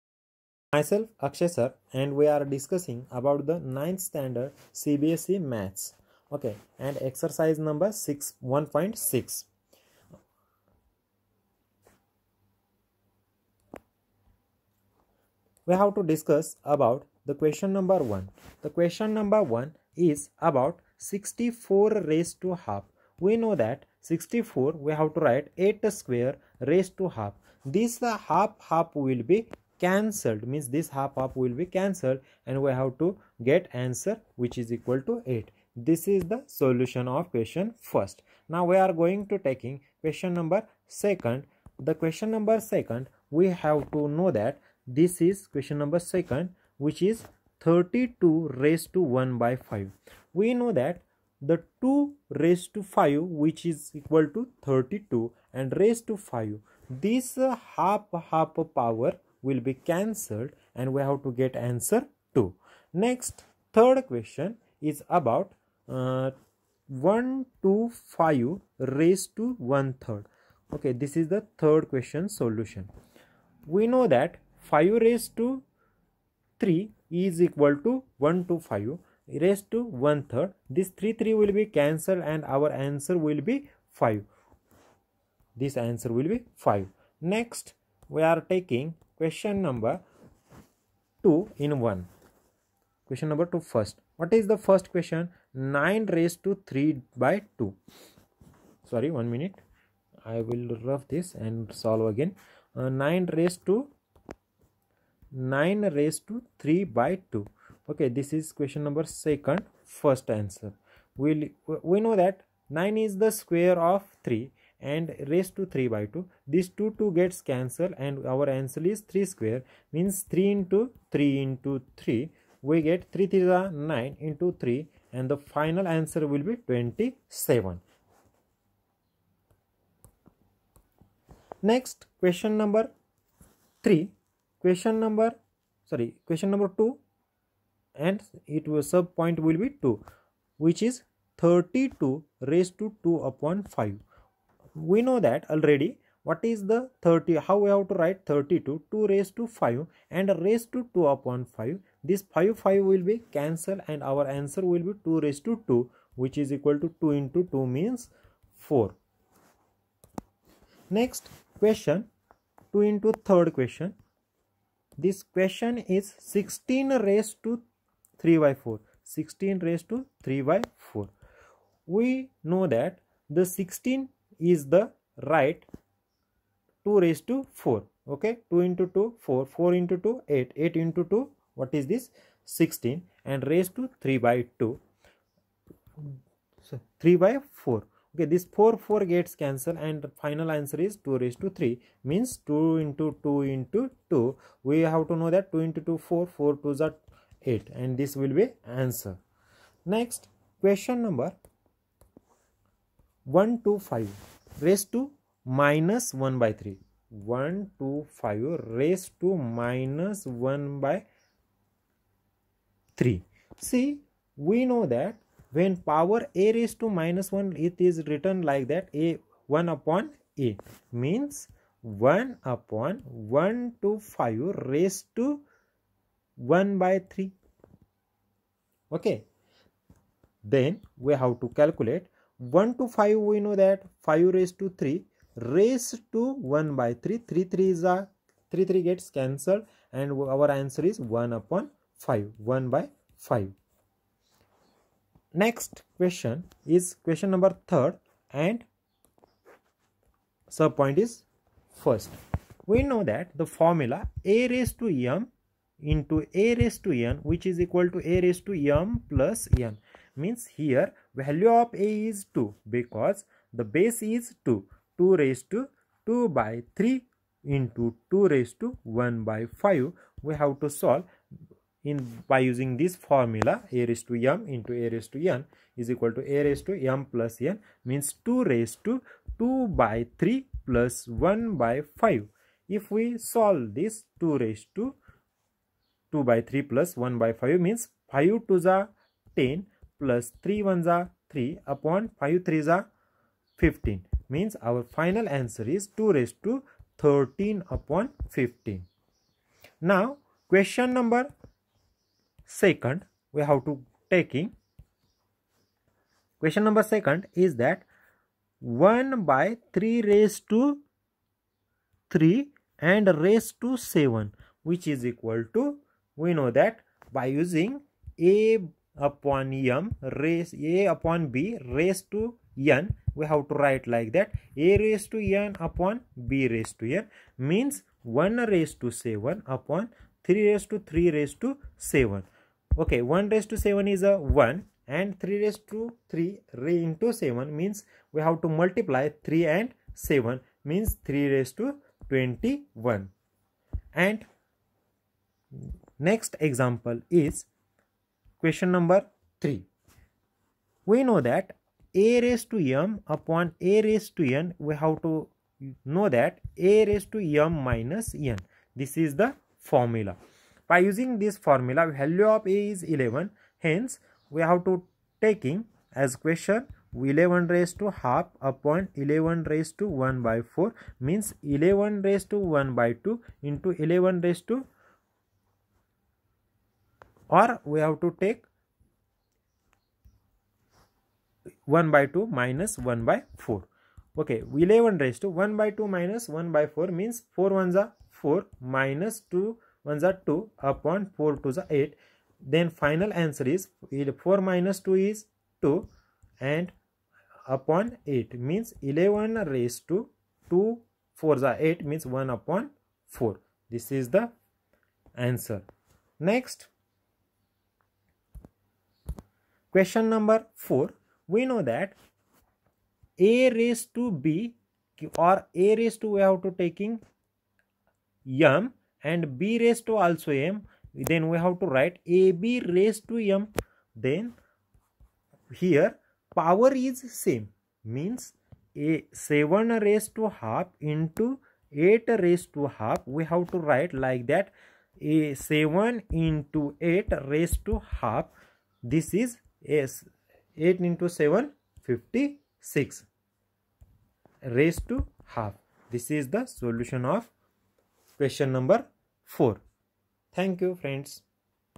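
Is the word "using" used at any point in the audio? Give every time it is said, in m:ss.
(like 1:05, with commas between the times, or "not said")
4:32, 5:17, 6:00.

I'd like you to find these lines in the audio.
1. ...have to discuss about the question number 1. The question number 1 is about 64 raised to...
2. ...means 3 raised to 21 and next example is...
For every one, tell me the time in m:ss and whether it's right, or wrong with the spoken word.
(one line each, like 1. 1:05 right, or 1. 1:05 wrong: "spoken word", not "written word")
1. 0:15 right
2. 5:40 right.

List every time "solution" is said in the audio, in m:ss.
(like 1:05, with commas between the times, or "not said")
0:36, 1:12, 7:26.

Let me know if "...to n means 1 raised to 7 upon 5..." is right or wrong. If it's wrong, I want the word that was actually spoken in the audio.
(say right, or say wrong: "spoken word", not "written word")
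wrong: "3", not "5".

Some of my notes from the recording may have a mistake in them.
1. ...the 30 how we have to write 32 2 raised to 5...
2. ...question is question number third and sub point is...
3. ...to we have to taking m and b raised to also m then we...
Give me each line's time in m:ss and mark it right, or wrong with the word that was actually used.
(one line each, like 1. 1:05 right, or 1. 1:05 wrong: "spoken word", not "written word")
1. 2:26 right
2. 4:05 right
3. 6:56 right.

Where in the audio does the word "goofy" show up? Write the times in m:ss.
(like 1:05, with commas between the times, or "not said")
not said.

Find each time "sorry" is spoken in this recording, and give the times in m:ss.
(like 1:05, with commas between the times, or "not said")
1:38, 2:15.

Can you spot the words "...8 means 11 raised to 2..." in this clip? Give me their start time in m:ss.
6:38.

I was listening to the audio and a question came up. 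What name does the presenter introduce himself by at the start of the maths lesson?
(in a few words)
Akshay.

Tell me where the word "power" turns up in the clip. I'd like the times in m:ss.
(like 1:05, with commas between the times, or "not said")
0:58, 3:35, 7:06.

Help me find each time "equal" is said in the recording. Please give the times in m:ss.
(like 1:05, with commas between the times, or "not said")
0:34, 0:54, 1:17, 2:36, 4:17, 4:35, 5:15.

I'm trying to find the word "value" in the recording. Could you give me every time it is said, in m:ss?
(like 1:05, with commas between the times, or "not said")
4:21, 6:01.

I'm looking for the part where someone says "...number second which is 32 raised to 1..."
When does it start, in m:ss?
0:45.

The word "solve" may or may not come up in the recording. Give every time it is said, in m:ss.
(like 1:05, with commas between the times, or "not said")
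1:41, 4:30, 4:43.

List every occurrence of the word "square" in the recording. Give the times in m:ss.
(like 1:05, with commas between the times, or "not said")
0:25, 1:53, 1:59.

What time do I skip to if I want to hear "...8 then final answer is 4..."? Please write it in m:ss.
6:31.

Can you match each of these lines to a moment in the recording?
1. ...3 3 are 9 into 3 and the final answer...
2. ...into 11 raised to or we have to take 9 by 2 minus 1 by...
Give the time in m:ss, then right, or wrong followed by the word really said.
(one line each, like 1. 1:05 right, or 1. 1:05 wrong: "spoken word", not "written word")
1. 2:03 right
2. 6:13 wrong: "1", not "9".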